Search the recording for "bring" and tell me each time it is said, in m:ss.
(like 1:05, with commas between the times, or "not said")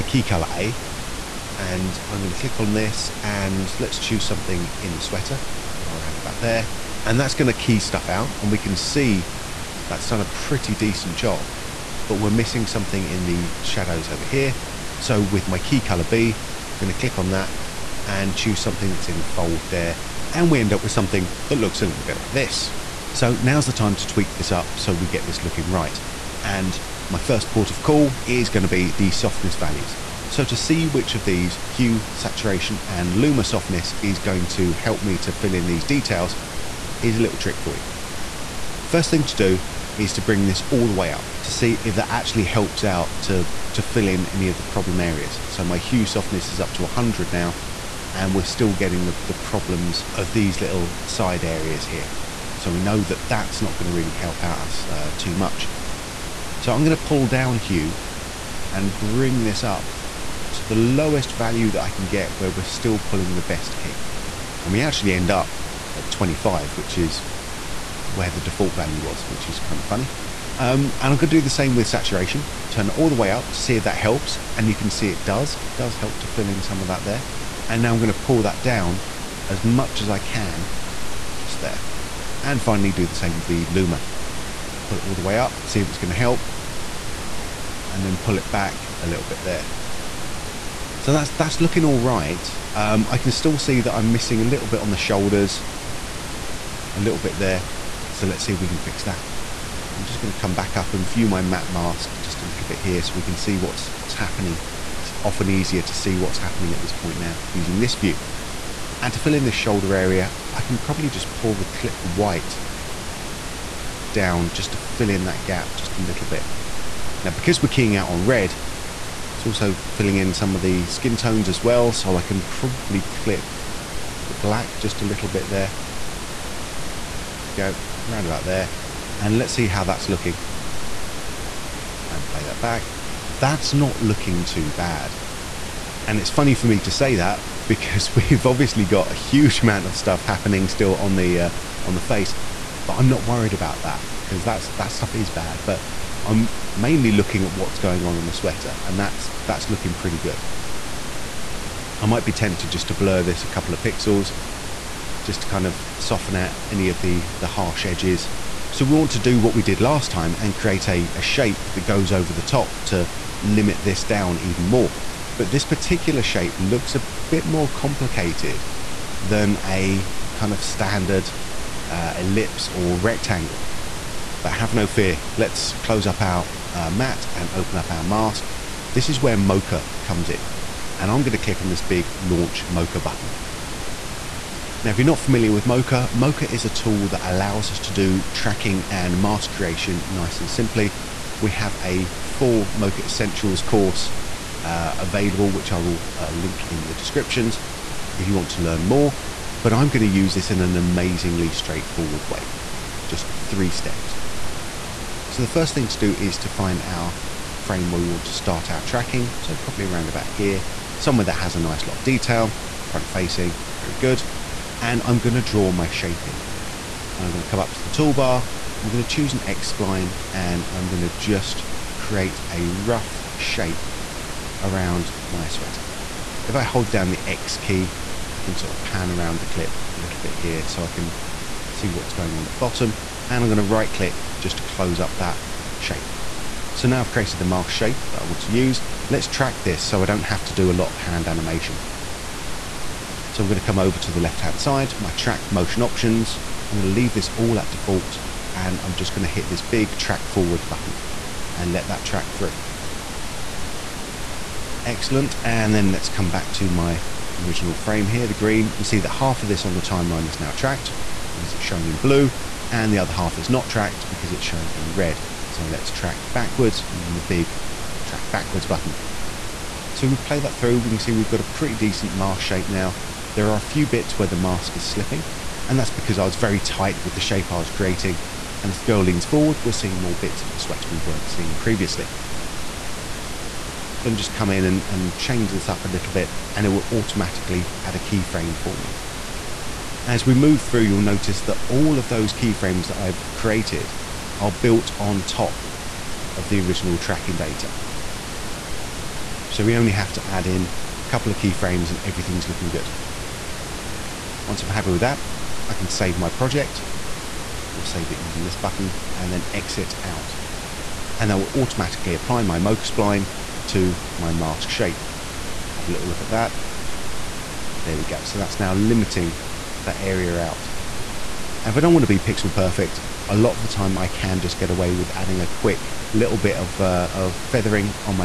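0:40, 0:58.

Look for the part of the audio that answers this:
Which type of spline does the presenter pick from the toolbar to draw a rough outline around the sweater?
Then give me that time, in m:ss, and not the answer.
3:39.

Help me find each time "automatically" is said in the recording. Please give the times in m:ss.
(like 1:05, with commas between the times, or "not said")
4:46, 5:11.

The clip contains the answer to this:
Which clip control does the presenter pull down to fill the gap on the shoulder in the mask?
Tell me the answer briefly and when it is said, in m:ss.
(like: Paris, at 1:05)
clip white, at 1:51.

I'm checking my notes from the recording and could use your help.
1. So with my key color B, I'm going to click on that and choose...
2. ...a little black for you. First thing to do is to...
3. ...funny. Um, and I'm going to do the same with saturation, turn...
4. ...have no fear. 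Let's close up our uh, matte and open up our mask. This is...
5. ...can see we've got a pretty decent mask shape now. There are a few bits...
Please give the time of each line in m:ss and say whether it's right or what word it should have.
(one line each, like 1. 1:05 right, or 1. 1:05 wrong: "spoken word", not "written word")
1. 0:14 right
2. 0:37 wrong: "trick", not "black"
3. 1:09 right
4. 2:54 right
5. 4:30 right.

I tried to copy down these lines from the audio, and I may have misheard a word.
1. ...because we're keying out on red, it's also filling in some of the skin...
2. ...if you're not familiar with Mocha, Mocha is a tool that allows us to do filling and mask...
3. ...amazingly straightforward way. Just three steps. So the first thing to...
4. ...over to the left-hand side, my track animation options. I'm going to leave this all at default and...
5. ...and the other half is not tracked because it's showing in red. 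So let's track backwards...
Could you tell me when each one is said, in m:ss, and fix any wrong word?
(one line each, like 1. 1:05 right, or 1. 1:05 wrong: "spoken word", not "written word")
1. 1:57 right
2. 3:04 wrong: "tracking", not "filling"
3. 3:20 right
4. 4:03 wrong: "motion", not "animation"
5. 4:22 right.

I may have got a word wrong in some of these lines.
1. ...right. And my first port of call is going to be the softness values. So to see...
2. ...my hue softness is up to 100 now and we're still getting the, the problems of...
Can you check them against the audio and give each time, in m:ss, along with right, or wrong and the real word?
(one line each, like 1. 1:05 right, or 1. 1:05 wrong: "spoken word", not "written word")
1. 0:25 right
2. 0:45 right.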